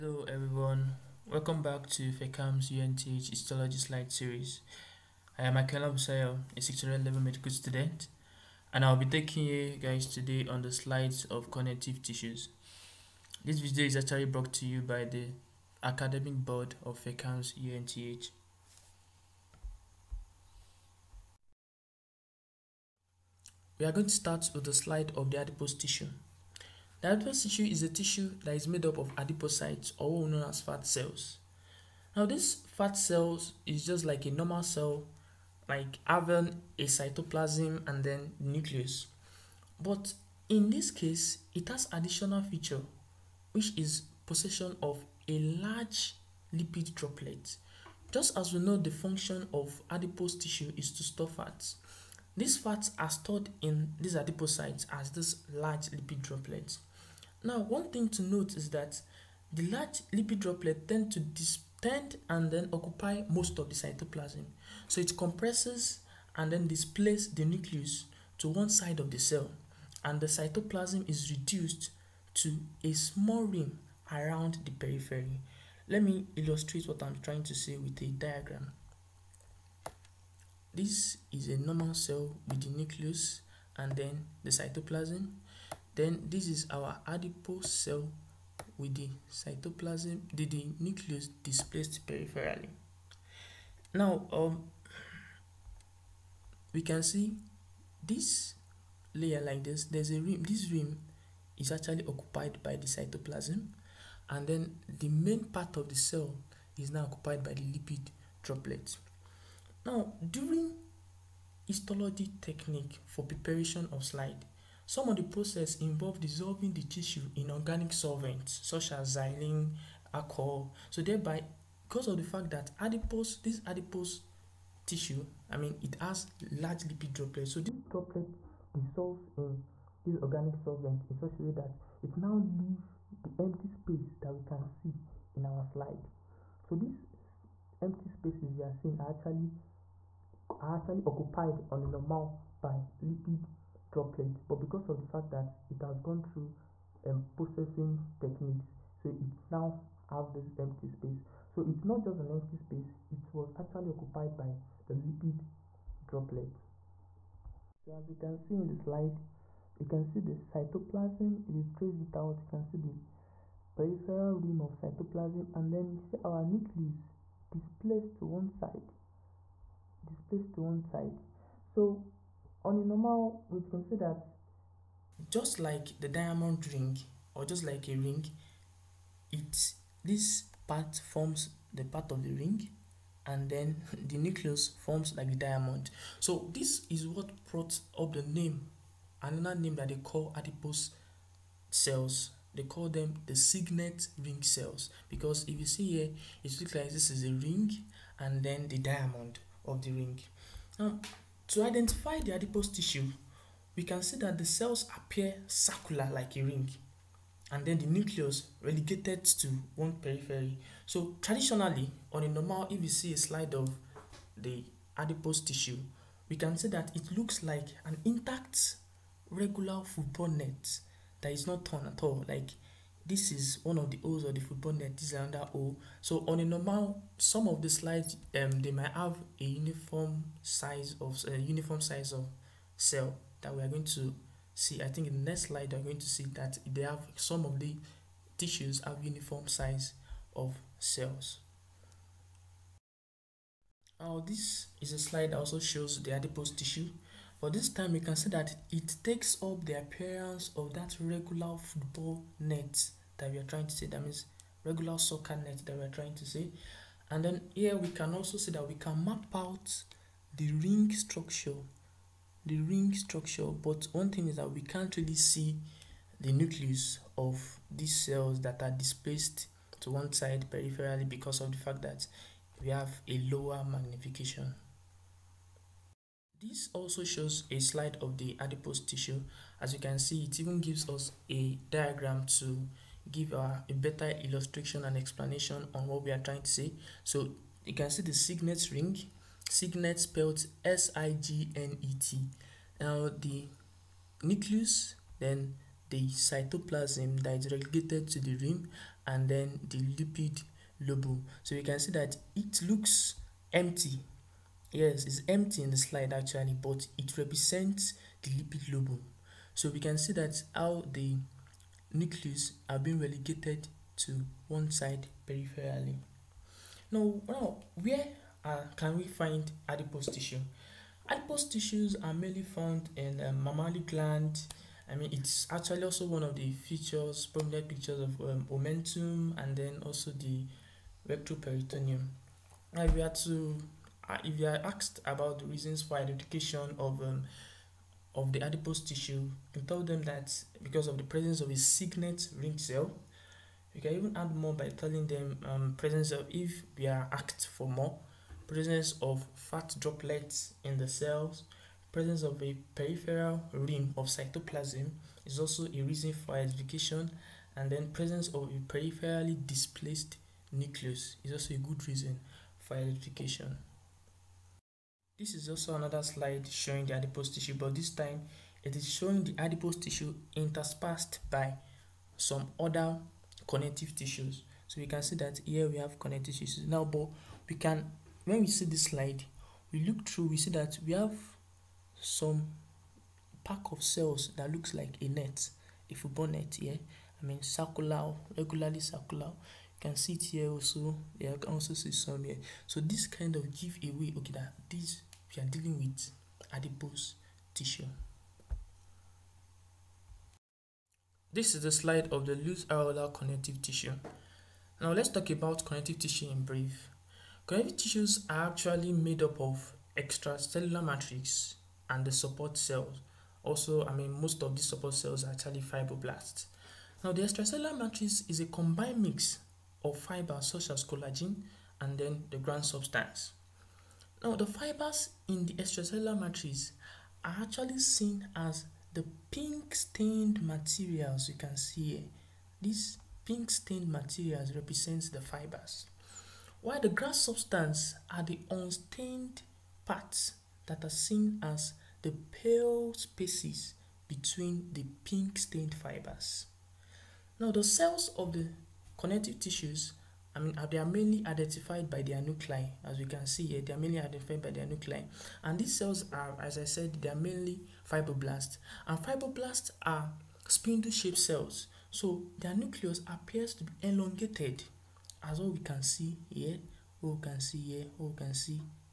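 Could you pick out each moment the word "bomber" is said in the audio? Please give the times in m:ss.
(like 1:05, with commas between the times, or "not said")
not said.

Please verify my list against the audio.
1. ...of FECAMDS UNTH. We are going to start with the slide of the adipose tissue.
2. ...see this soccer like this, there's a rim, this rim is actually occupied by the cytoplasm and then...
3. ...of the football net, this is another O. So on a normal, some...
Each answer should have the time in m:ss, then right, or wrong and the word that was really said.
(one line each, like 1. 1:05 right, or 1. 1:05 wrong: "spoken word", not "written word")
1. 0:16 right
2. 1:37 wrong: "layer", not "soccer"
3. 3:44 right.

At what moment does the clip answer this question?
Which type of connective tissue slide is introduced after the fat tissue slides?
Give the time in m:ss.
6:42.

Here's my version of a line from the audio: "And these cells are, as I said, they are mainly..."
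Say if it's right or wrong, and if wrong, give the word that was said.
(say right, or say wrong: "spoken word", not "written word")
right.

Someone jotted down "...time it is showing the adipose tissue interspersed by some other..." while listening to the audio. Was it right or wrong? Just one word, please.
right.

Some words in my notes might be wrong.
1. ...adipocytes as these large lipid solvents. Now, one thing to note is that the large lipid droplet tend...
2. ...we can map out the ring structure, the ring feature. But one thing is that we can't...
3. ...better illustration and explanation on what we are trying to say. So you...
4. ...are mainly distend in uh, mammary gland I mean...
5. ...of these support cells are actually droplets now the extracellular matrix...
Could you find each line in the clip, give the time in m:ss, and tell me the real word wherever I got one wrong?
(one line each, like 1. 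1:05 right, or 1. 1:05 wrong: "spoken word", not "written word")
1. 0:54 wrong: "droplets", not "solvents"
2. 4:18 wrong: "structure", not "feature"
3. 4:43 right
4. 5:22 wrong: "found", not "distend"
5. 6:54 wrong: "fibroblasts", not "droplets".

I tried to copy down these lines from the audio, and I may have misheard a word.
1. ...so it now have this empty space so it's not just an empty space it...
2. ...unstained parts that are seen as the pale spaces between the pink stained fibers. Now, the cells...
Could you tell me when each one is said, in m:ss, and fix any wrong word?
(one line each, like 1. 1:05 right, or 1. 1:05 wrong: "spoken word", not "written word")
1. 2:28 right
2. 7:18 right.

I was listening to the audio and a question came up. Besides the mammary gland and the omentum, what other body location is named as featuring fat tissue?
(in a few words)
retroperitoneum.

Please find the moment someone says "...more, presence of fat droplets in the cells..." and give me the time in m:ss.
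5:47.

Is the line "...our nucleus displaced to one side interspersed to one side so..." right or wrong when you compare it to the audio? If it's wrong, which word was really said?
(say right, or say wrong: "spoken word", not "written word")
wrong: "displaced", not "interspersed".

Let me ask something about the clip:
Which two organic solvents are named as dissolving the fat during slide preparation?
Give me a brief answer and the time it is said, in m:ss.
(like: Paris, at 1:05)
xylene, alcohol, at 1:59.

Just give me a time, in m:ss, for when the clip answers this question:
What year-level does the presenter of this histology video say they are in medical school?
0:06.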